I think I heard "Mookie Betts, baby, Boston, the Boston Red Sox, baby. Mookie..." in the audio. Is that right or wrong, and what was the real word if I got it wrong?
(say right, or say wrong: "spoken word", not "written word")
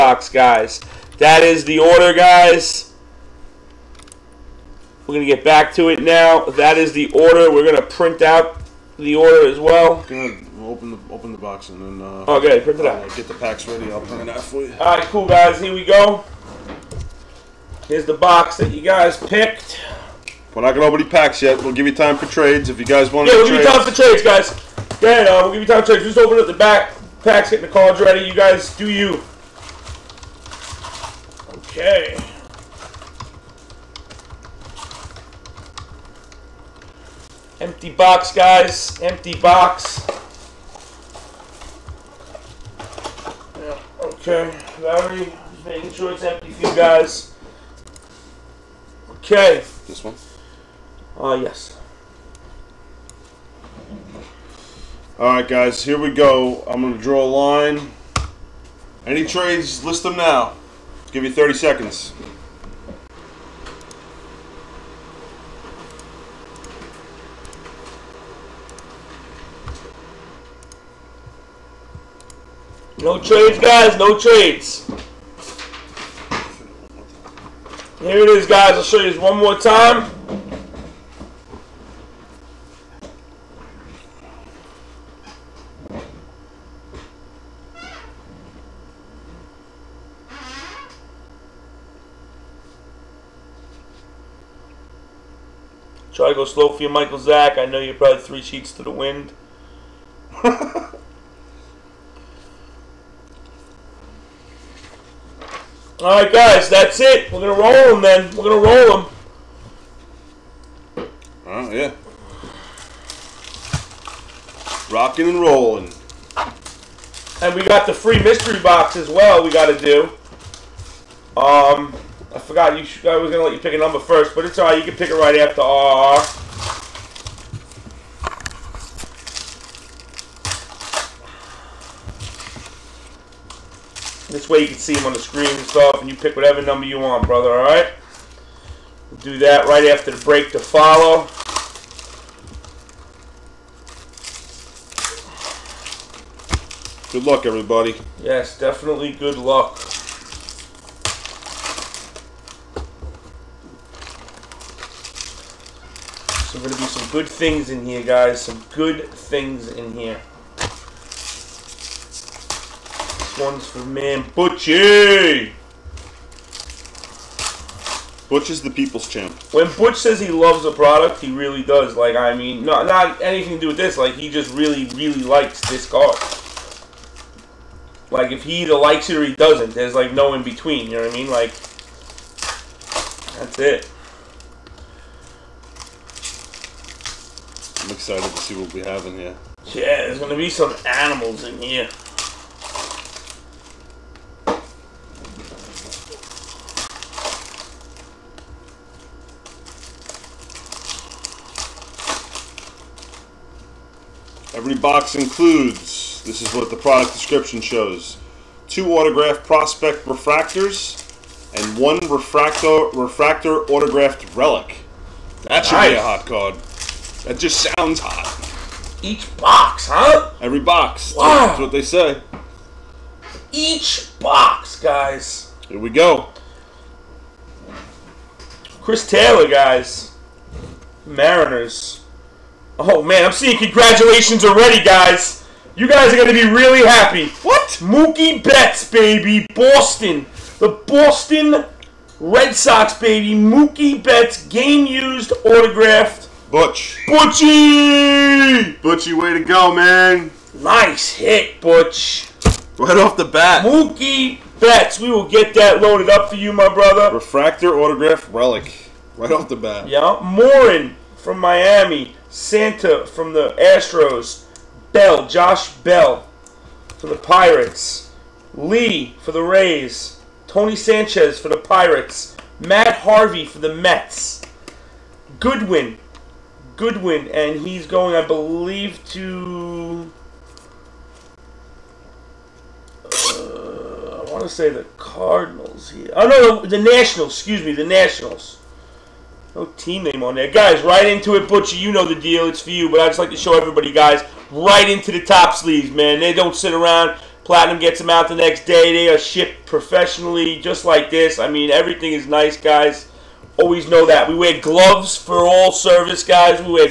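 right.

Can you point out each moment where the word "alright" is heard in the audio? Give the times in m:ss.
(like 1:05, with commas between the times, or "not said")
0:55, 2:04, 2:17.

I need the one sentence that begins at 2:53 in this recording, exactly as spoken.
Like, he just really, really likes this card.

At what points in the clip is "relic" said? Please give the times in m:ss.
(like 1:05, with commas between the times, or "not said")
3:34, 4:18.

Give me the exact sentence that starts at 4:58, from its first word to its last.
They are shipped professionally, just like this.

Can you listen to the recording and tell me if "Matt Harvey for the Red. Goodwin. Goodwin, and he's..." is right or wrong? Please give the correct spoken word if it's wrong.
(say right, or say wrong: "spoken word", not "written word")
wrong: "Mets", not "Red".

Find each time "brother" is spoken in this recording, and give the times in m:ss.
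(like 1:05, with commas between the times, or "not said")
2:17, 4:16.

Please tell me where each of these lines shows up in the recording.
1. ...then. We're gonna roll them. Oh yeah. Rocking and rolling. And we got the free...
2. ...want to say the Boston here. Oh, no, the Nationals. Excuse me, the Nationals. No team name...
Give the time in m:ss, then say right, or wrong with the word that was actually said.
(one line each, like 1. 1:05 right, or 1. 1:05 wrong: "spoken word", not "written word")
1. 1:48 right
2. 4:44 wrong: "Cardinals", not "Boston".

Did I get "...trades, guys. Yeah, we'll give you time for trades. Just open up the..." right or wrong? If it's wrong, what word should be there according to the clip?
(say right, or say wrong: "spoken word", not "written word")
right.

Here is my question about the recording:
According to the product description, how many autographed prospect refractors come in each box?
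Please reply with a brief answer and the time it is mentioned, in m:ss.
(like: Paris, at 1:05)
2, at 3:28.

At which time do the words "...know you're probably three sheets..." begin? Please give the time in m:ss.
1:37.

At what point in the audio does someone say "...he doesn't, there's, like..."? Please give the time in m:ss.
2:59.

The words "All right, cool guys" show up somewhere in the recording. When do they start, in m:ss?
0:14.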